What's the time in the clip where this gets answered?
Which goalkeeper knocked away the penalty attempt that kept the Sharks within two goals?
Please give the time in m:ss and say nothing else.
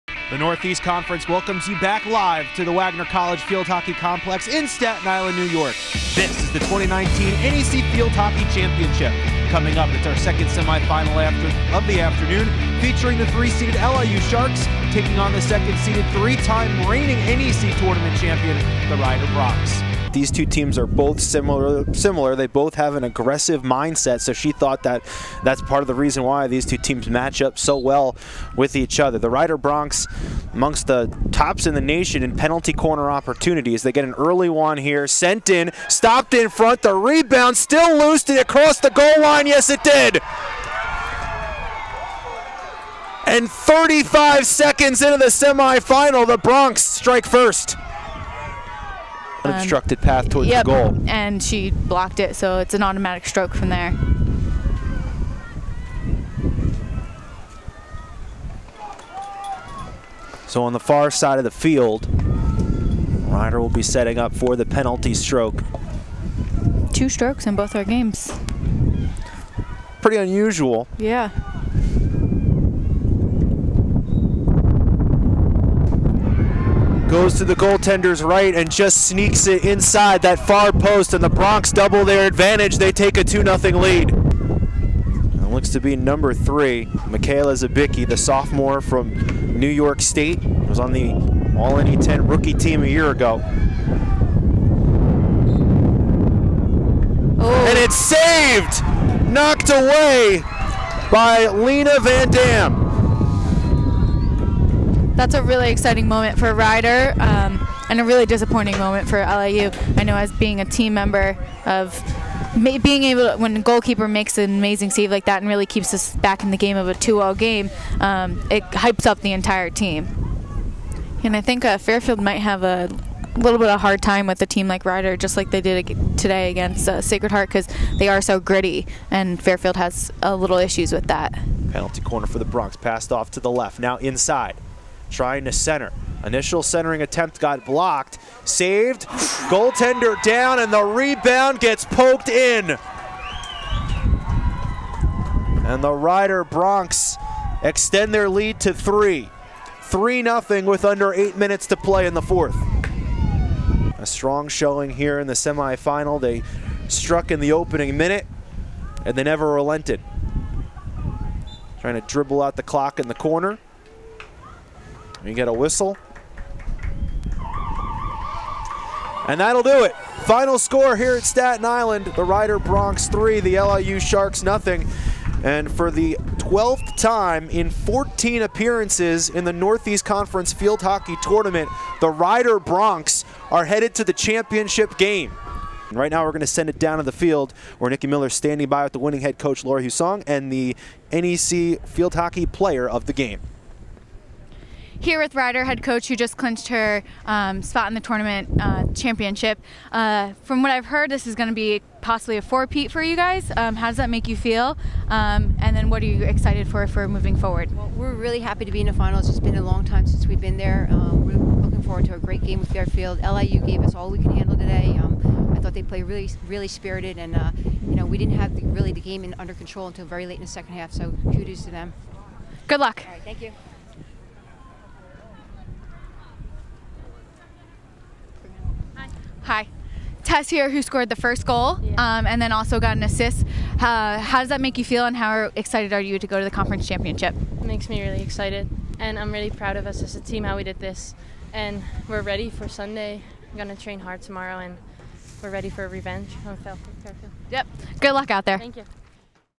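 1:41.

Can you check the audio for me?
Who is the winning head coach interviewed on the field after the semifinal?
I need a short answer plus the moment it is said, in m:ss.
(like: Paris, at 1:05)
Laura Hussong, at 3:09.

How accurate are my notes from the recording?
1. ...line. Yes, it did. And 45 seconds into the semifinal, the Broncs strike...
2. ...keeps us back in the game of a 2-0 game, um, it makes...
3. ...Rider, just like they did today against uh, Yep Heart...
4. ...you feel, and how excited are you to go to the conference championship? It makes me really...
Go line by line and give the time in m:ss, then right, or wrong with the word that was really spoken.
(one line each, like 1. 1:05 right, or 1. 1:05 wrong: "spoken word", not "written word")
1. 0:39 wrong: "35", not "45"
2. 1:55 wrong: "hypes", not "makes"
3. 2:04 wrong: "Sacred", not "Yep"
4. 3:54 right.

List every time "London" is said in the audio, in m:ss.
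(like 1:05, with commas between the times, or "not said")
not said.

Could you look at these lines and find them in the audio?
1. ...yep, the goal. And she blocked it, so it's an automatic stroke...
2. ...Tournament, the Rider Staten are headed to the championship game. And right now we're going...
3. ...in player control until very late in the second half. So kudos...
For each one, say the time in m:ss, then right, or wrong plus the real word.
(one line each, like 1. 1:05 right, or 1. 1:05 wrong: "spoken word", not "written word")
1. 0:50 right
2. 3:01 wrong: "Broncs", not "Staten"
3. 3:39 wrong: "under", not "player".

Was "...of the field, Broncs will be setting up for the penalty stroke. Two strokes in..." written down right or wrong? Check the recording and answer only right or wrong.
wrong.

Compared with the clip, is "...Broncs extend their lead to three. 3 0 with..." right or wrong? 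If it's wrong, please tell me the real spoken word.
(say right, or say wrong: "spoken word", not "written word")
right.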